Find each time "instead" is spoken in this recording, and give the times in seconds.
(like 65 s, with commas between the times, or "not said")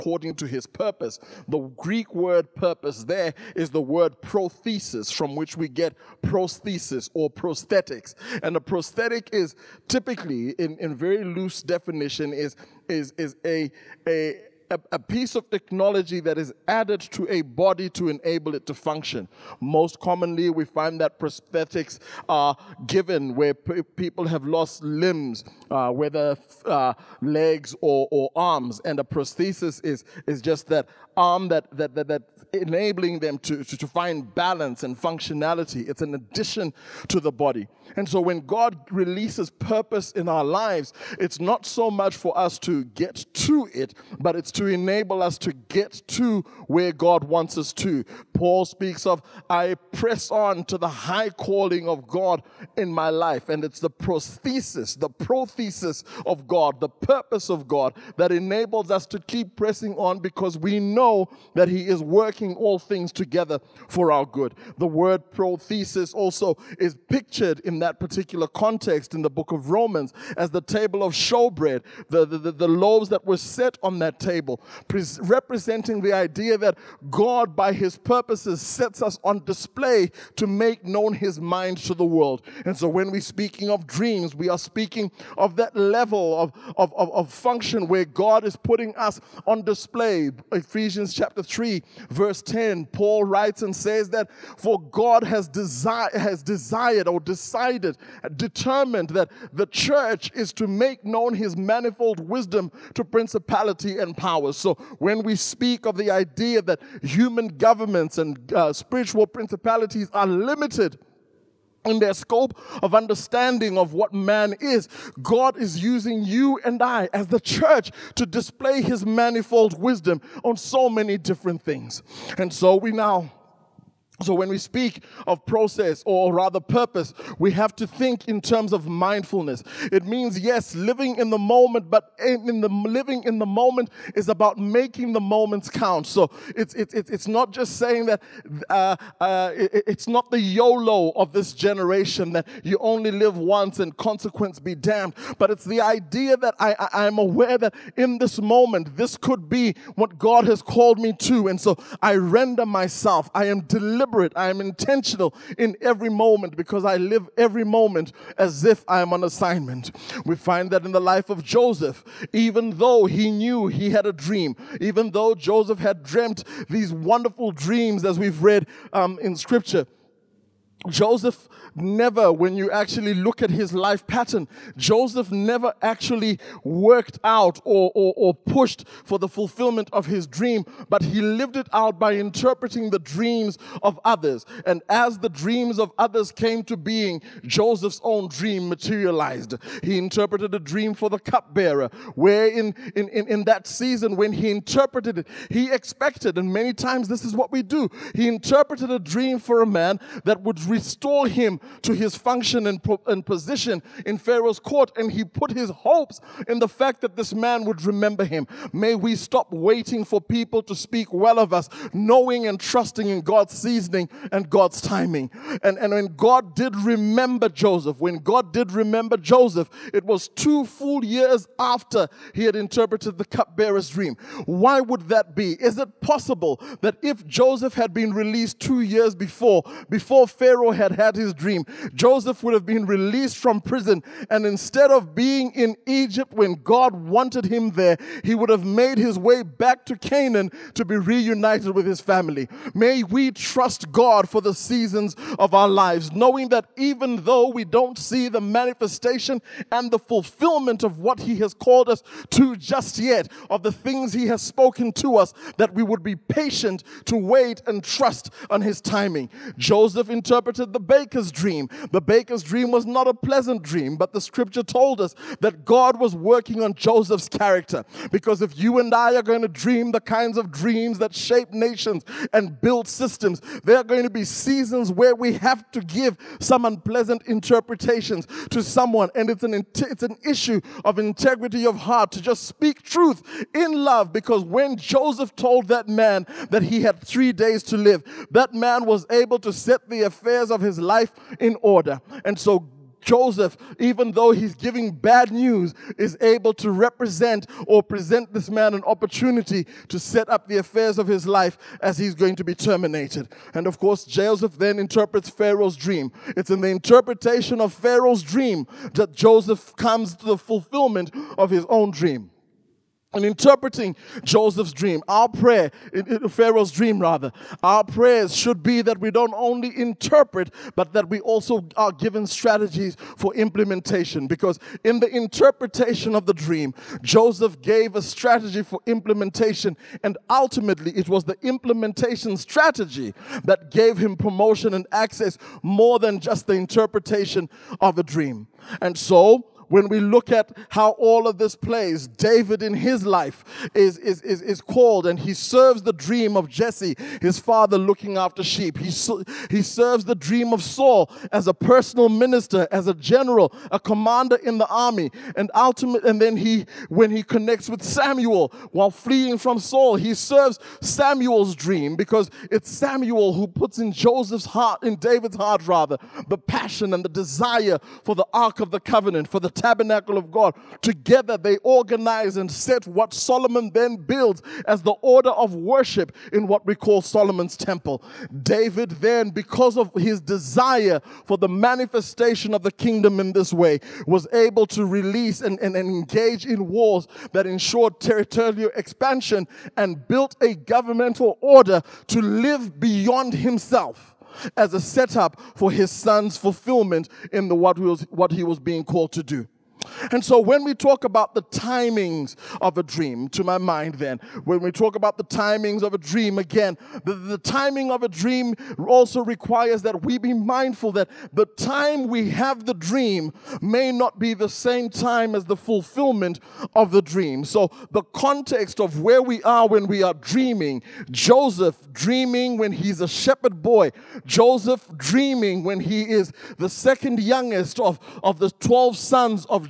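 234 s.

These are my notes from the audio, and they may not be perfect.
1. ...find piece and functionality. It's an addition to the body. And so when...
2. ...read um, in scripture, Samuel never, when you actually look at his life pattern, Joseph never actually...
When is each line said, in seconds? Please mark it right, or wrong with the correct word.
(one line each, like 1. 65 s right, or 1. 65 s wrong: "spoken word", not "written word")
1. 33 s wrong: "balance", not "piece"
2. 168 s wrong: "Joseph", not "Samuel".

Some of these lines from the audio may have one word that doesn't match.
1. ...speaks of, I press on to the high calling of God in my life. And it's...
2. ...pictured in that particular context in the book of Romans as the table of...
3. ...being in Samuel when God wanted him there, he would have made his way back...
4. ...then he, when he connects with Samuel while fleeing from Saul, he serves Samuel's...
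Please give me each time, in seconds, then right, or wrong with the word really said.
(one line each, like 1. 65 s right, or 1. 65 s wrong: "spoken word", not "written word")
1. 48 s right
2. 67 s right
3. 235 s wrong: "Egypt", not "Samuel"
4. 356 s right.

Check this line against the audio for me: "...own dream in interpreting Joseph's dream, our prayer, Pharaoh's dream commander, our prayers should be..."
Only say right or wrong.
wrong.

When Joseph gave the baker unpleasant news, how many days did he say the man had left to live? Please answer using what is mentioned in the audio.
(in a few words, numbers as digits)
3.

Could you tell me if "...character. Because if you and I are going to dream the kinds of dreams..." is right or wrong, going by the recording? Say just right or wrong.
right.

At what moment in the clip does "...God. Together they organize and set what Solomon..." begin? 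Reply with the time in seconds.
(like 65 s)
370 s.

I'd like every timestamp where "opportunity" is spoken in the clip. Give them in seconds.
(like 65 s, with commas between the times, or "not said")
298 s.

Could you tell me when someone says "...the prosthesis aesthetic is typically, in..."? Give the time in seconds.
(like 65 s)
8 s.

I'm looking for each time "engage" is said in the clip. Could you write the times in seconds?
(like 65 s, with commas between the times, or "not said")
385 s.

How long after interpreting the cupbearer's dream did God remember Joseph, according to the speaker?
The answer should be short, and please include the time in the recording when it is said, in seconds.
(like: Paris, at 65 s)
2 years, at 220 s.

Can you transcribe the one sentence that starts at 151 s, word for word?
And so, I render myself, I am deliberate deliberate.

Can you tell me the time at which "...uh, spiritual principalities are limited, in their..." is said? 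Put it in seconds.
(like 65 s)
108 s.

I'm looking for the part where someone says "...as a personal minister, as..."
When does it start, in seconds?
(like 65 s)
351 s.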